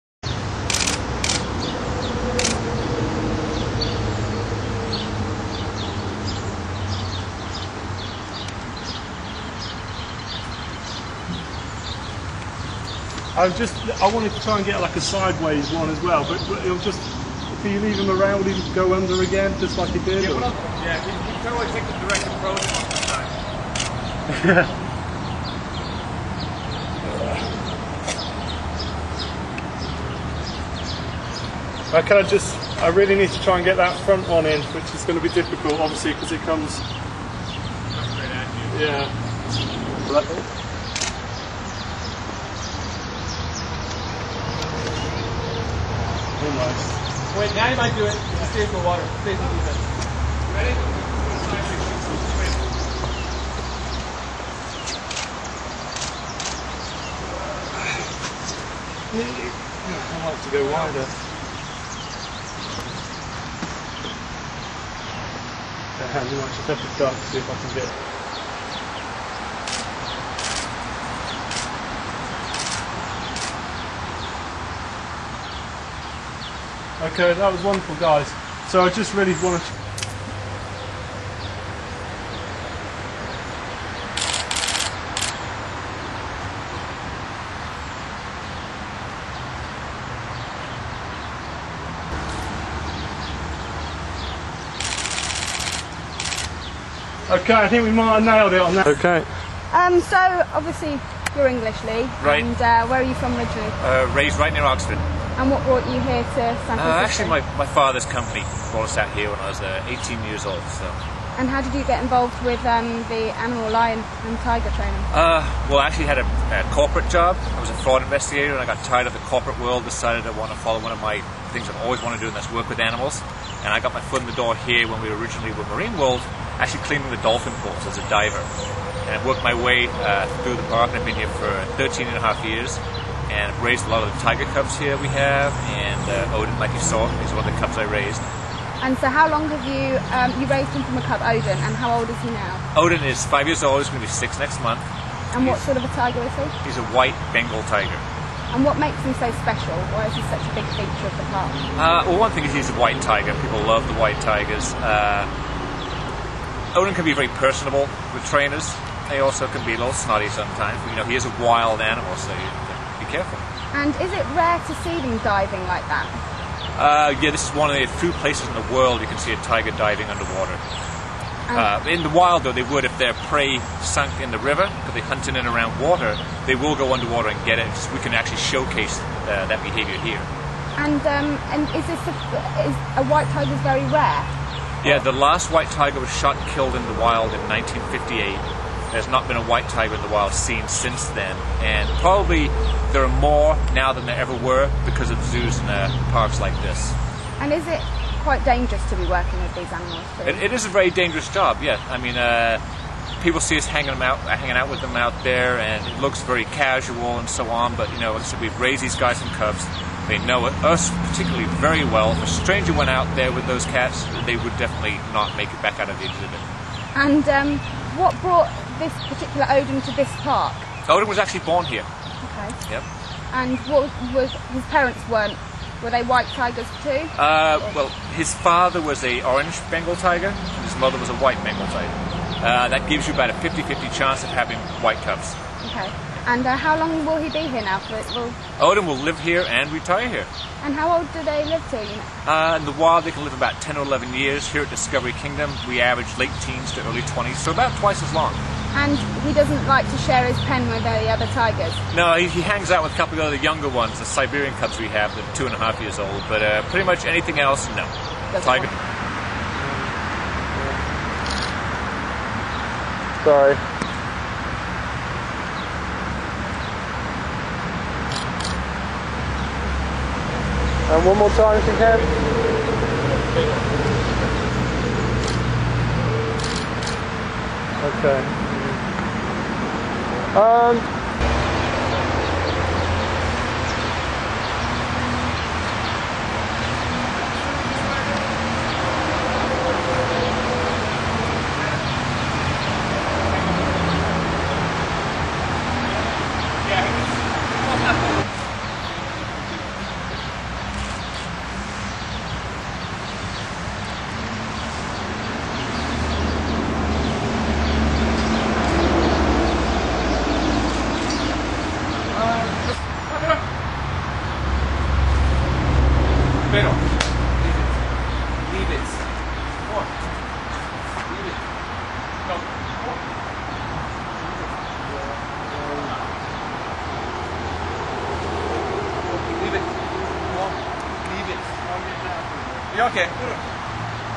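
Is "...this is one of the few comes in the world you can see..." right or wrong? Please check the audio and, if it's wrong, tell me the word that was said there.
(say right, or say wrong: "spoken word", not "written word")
wrong: "places", not "comes".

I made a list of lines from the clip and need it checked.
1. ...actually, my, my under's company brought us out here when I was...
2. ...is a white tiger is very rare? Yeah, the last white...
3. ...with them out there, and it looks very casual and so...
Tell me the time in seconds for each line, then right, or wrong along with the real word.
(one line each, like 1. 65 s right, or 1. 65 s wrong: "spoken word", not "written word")
1. 107 s wrong: "father", not "under"
2. 182 s right
3. 204 s right.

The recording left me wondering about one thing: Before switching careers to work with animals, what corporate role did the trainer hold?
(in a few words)
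fraud investigator.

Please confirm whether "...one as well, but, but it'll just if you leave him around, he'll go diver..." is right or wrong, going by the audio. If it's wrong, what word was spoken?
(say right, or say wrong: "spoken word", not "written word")
wrong: "under", not "diver".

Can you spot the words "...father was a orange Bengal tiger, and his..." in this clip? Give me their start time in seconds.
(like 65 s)
228 s.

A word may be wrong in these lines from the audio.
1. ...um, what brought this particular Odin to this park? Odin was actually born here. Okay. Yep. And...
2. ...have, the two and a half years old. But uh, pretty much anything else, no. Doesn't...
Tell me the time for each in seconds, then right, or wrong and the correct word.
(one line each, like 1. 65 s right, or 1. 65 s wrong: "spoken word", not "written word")
1. 217 s right
2. 254 s right.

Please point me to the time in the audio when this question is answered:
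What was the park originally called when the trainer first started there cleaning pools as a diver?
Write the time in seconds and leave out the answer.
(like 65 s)
125 s.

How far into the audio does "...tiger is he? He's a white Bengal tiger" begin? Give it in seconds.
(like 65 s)
145 s.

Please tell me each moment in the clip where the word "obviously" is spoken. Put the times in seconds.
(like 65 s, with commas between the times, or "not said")
35 s, 100 s.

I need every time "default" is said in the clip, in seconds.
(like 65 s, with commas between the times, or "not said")
not said.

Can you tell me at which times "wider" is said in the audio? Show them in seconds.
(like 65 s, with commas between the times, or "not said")
60 s.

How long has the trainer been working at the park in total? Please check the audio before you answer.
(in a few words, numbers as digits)
13 and a half years.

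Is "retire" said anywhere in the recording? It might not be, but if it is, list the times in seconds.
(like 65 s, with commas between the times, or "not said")
239 s.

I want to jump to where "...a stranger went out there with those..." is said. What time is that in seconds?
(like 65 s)
212 s.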